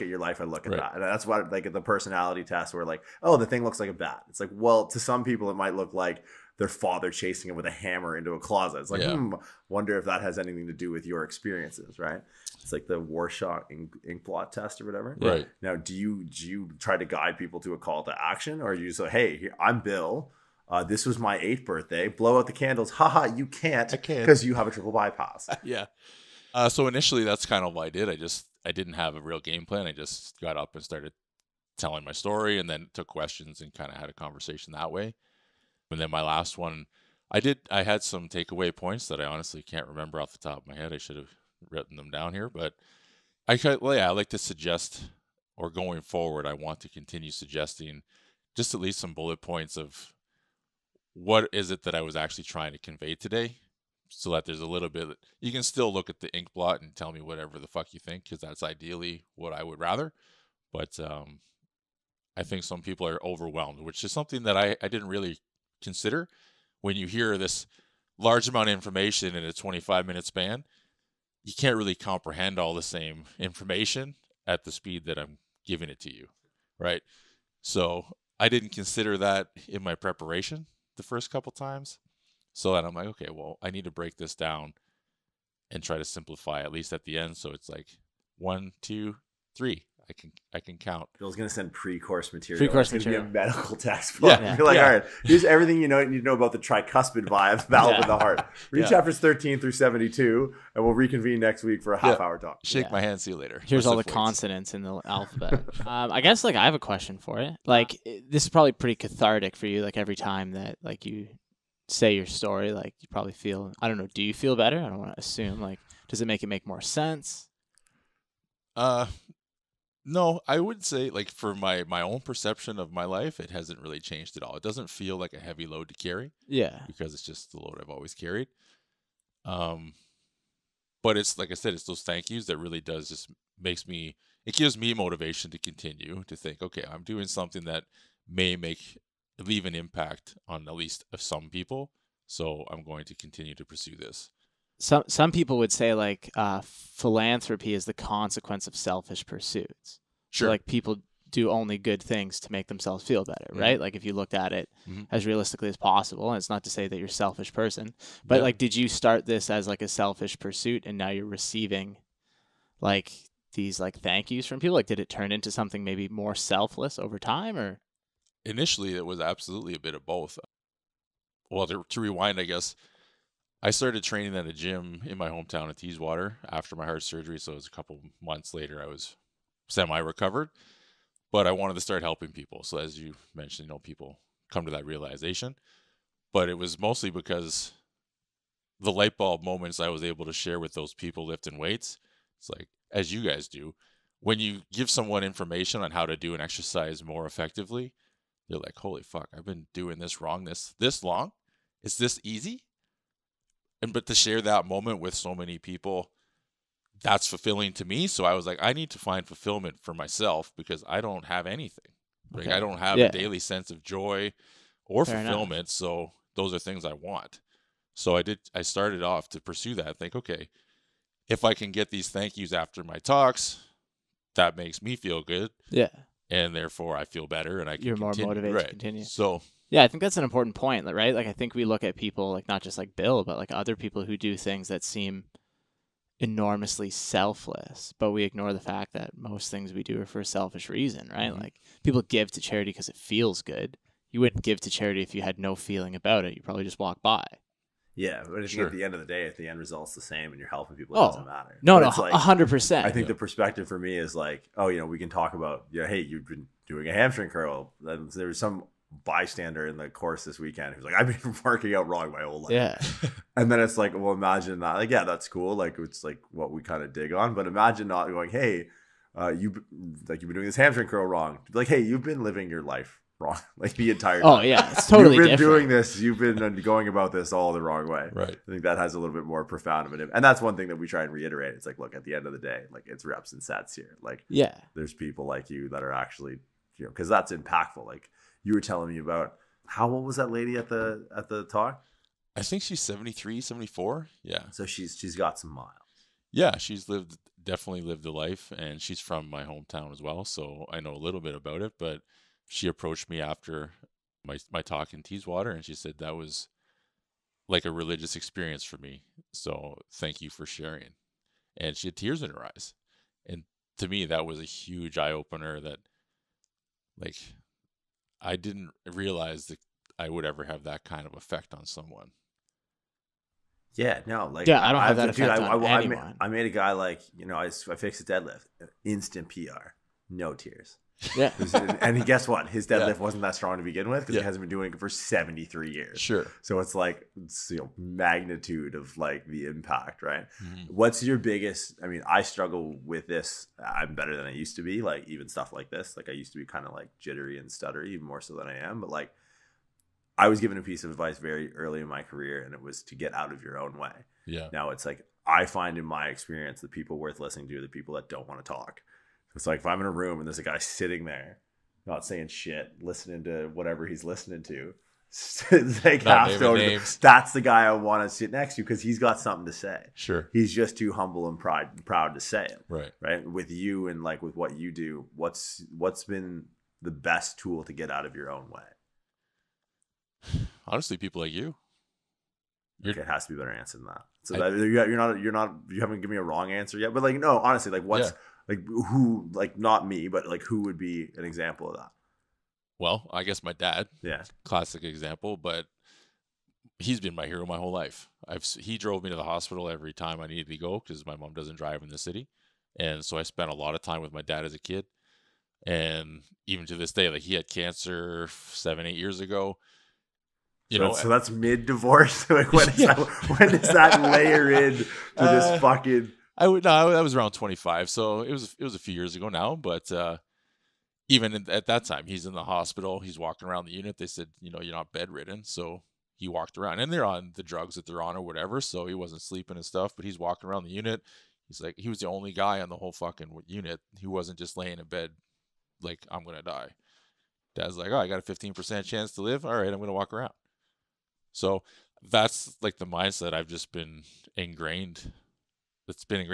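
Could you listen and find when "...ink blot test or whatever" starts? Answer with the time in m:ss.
0:14.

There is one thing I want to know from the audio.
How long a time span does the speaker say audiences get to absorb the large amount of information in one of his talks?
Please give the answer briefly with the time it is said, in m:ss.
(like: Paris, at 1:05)
25 minutes, at 1:09.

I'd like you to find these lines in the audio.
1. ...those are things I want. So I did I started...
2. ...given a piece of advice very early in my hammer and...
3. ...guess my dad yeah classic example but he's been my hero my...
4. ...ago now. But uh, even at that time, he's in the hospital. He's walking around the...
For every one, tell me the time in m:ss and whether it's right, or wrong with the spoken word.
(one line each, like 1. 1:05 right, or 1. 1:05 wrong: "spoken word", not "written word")
1. 3:36 right
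2. 5:50 wrong: "career", not "hammer"
3. 6:33 right
4. 6:59 right.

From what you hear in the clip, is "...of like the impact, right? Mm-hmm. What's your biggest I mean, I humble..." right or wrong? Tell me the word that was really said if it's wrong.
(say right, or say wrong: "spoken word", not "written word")
wrong: "struggle", not "humble".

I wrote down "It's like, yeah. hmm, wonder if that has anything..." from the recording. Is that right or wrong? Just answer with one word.
right.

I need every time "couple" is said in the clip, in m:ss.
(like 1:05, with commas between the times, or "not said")
1:21, 2:57.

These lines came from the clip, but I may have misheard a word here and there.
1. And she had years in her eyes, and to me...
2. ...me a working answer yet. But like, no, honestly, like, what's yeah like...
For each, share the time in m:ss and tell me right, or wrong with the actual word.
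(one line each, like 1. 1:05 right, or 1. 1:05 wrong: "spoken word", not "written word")
1. 5:11 wrong: "tears", not "years"
2. 6:26 wrong: "wrong", not "working".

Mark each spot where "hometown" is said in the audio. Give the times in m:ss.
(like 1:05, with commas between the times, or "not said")
2:55, 4:59.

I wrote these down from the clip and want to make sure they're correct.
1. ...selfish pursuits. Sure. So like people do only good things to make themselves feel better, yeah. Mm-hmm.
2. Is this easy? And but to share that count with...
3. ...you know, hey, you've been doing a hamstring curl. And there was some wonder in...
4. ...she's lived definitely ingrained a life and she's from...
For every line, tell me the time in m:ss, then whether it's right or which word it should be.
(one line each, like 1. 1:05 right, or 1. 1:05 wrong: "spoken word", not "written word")
1. 2:28 right
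2. 3:21 wrong: "moment", not "count"
3. 4:15 wrong: "bystander", not "wonder"
4. 4:56 wrong: "lived", not "ingrained".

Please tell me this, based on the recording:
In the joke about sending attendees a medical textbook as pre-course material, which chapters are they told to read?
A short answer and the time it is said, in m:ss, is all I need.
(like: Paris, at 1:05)
Chapters 13 through 72, at 1:39.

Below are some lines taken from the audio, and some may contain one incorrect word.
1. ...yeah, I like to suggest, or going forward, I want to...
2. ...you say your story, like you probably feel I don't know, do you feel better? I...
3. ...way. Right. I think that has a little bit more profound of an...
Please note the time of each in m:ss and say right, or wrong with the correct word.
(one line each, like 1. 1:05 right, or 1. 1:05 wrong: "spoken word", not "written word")
1. 0:43 right
2. 1:51 right
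3. 4:37 right.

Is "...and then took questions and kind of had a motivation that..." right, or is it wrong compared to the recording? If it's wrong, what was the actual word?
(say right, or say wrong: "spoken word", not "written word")
wrong: "conversation", not "motivation".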